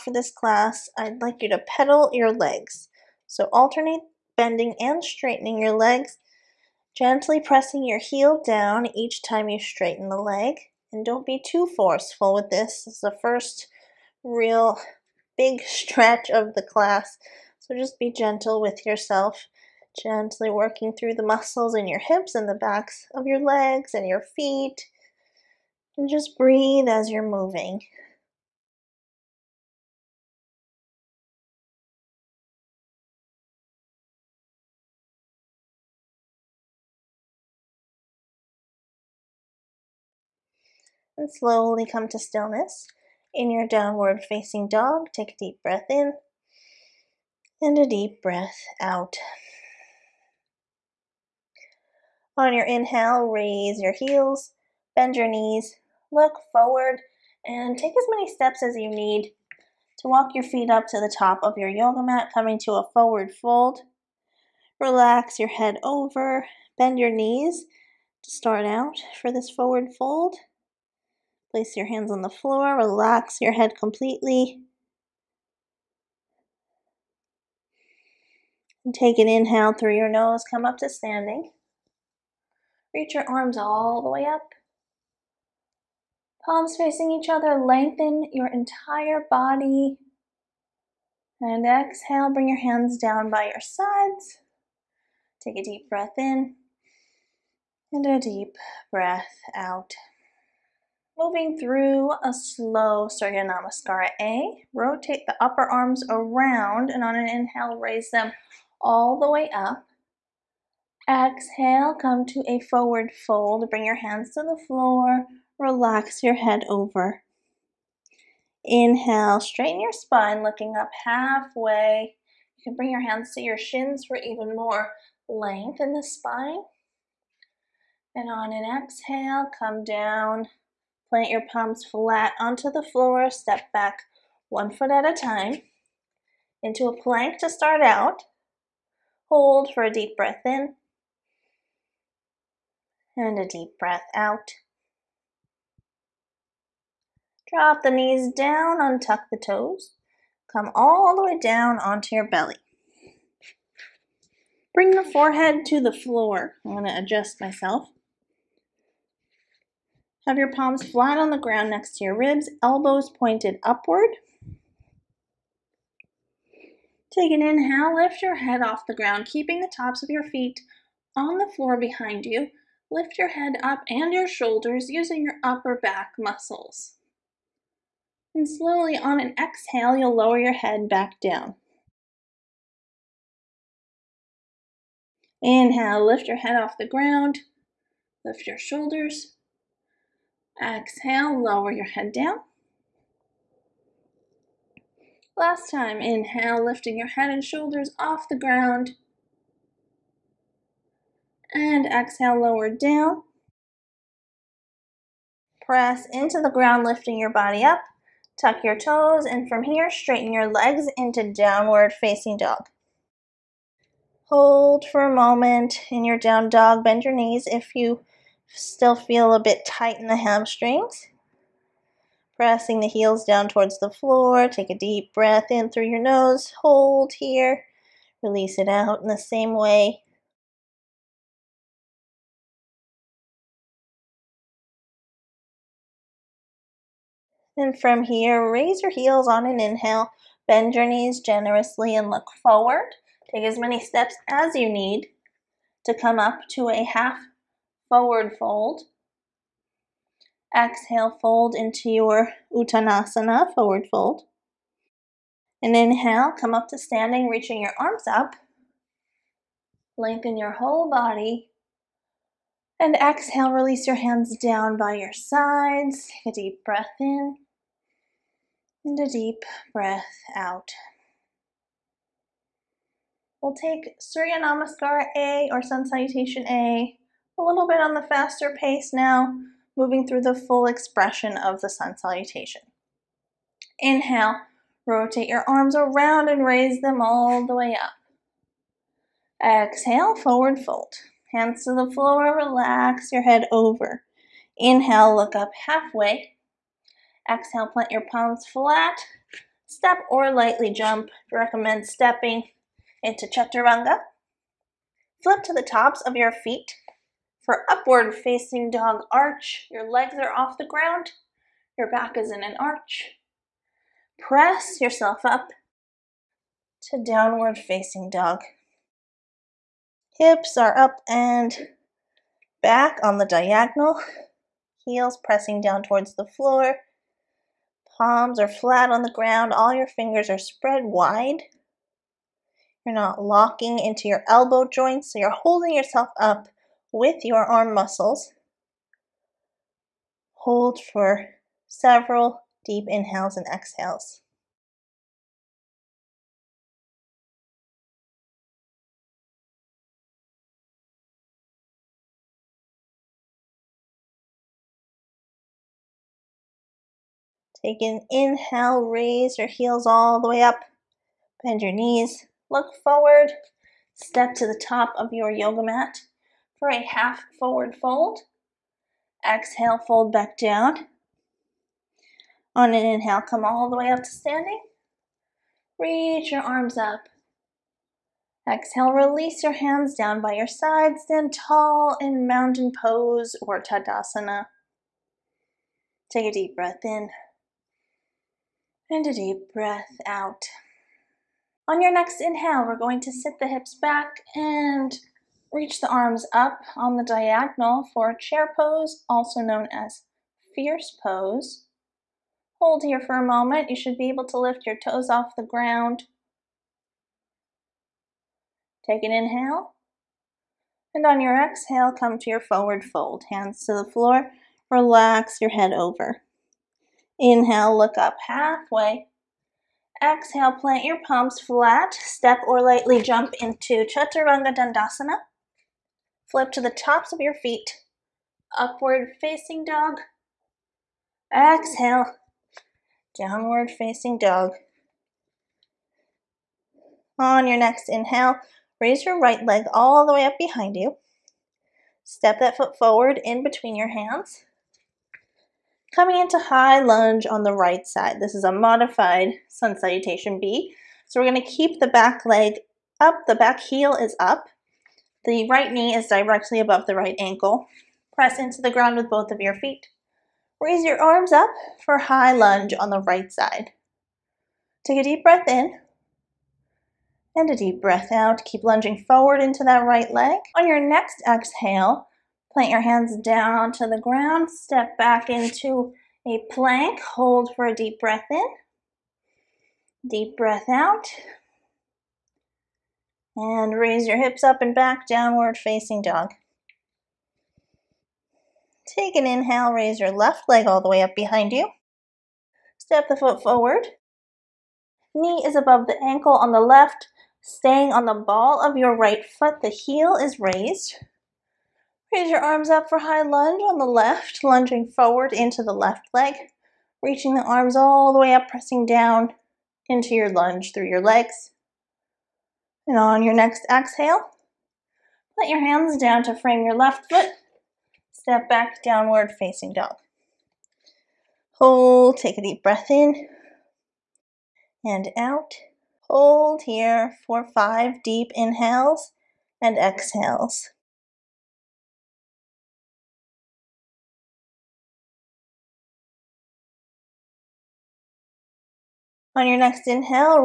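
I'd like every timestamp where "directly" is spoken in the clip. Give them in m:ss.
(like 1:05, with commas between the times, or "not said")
7:36.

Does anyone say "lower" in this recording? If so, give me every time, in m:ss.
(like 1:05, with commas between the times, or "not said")
3:00, 3:11, 3:22.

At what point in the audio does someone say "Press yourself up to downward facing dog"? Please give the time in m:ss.
5:14.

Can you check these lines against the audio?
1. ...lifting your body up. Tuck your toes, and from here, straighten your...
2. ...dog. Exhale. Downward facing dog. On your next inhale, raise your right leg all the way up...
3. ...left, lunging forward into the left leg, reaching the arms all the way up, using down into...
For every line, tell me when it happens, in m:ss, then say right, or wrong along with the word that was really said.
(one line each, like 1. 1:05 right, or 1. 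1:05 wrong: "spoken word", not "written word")
1. 3:26 right
2. 7:09 right
3. 8:23 wrong: "pressing", not "using".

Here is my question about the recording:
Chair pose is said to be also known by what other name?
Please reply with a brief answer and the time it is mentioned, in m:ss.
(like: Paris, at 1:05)
fierce pose, at 6:40.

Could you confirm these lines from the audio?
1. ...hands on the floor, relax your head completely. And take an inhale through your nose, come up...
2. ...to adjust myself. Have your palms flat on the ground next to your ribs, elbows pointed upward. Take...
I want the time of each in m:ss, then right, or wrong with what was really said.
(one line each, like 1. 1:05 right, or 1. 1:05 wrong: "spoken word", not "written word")
1. 1:11 right
2. 2:36 right.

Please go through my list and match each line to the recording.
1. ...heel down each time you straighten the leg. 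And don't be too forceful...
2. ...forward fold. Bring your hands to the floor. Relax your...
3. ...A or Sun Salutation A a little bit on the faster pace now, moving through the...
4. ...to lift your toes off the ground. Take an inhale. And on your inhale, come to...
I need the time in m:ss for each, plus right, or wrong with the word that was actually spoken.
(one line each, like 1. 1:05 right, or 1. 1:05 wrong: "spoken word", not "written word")
1. 0:07 right
2. 1:52 right
3. 4:35 right
4. 6:44 wrong: "exhale", not "inhale".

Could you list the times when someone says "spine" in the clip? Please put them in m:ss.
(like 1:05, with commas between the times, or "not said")
1:59, 2:06.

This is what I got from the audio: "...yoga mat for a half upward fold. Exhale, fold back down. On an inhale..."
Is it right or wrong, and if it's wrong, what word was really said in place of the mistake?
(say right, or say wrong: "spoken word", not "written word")
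wrong: "forward", not "upward".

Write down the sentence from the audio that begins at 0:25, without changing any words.
And just breathe as you're moving.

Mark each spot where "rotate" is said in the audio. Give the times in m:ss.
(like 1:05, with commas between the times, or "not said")
1:44, 4:44.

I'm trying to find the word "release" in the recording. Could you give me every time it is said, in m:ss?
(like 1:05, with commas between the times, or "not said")
3:48, 4:23, 6:18.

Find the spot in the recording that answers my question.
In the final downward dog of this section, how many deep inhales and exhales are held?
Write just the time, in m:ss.
8:47.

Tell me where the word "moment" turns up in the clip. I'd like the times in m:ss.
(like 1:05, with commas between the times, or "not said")
3:35, 6:43.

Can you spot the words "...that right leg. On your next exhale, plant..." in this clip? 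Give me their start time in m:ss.
7:49.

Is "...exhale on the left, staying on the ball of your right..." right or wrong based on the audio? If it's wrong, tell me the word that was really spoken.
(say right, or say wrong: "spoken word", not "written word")
wrong: "ankle", not "exhale".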